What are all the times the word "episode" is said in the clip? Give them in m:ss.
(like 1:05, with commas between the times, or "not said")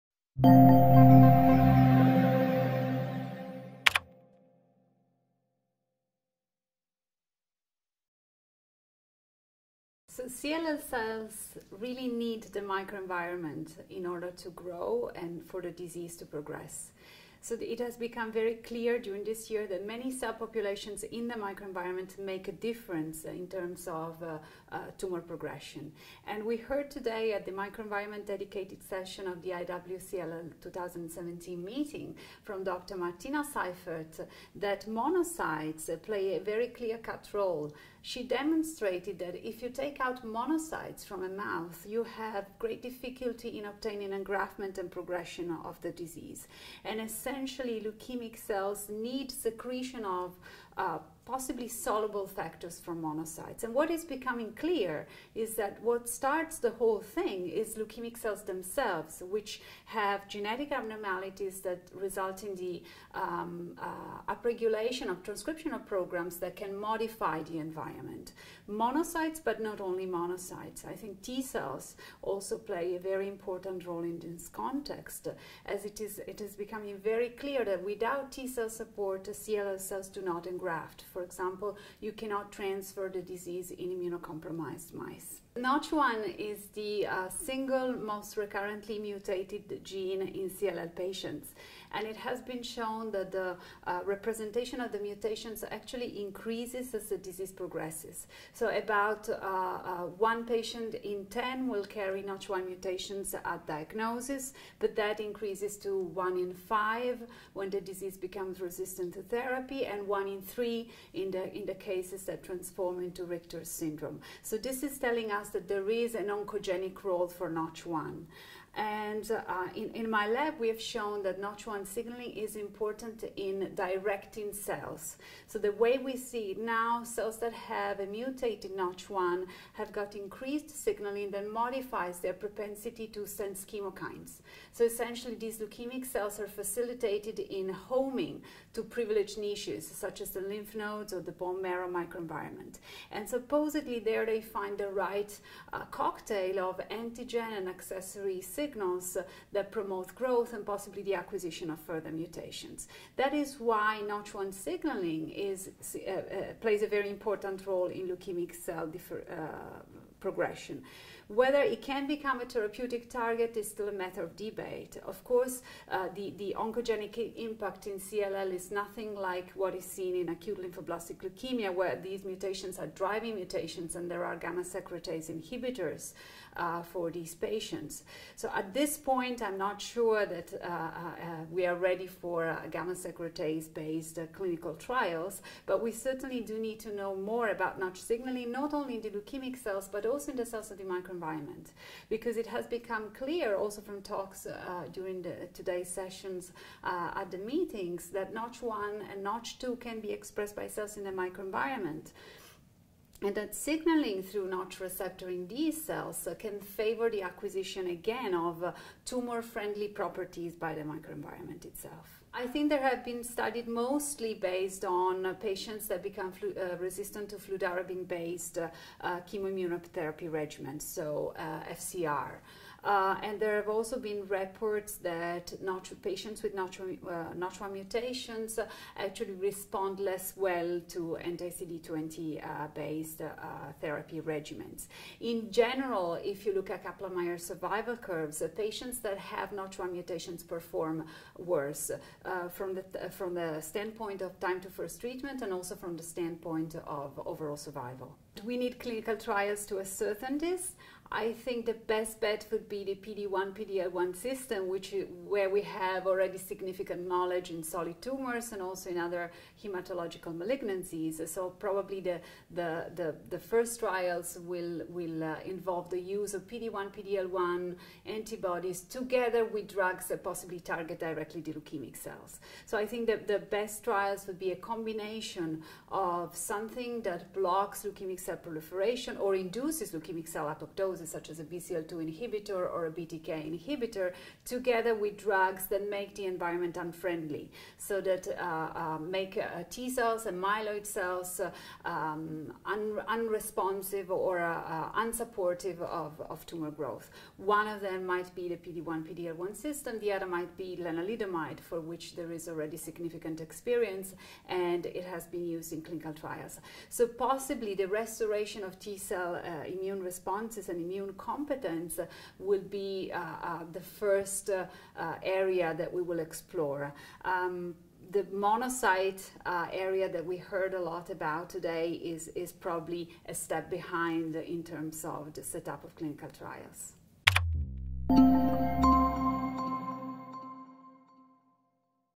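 not said.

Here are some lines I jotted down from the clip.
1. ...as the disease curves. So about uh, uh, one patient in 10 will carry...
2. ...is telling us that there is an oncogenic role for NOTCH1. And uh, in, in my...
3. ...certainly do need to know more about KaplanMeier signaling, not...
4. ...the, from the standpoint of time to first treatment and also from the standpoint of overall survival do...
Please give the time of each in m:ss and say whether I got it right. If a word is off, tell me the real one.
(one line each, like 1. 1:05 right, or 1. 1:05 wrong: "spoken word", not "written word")
1. 1:36 wrong: "progresses", not "curves"
2. 1:54 right
3. 3:05 wrong: "Notch", not "KaplanMeier"
4. 4:02 right.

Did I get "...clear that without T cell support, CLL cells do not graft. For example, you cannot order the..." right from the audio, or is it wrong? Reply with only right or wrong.
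wrong.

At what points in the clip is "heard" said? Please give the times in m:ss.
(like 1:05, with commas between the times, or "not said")
0:26, 5:20.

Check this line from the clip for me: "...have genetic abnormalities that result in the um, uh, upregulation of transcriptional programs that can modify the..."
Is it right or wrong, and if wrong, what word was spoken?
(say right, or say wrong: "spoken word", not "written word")
right.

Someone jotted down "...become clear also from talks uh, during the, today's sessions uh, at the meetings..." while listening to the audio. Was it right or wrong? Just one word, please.
right.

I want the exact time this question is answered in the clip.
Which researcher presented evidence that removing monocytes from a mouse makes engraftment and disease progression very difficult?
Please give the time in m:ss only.
0:32.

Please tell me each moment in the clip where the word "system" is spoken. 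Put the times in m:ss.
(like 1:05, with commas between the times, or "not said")
4:14, 4:59.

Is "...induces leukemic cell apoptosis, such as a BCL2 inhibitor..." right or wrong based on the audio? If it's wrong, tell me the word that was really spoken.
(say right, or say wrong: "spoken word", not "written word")
right.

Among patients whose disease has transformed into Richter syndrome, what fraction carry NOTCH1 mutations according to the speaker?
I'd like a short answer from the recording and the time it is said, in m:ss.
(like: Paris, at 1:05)
one in three, at 1:50.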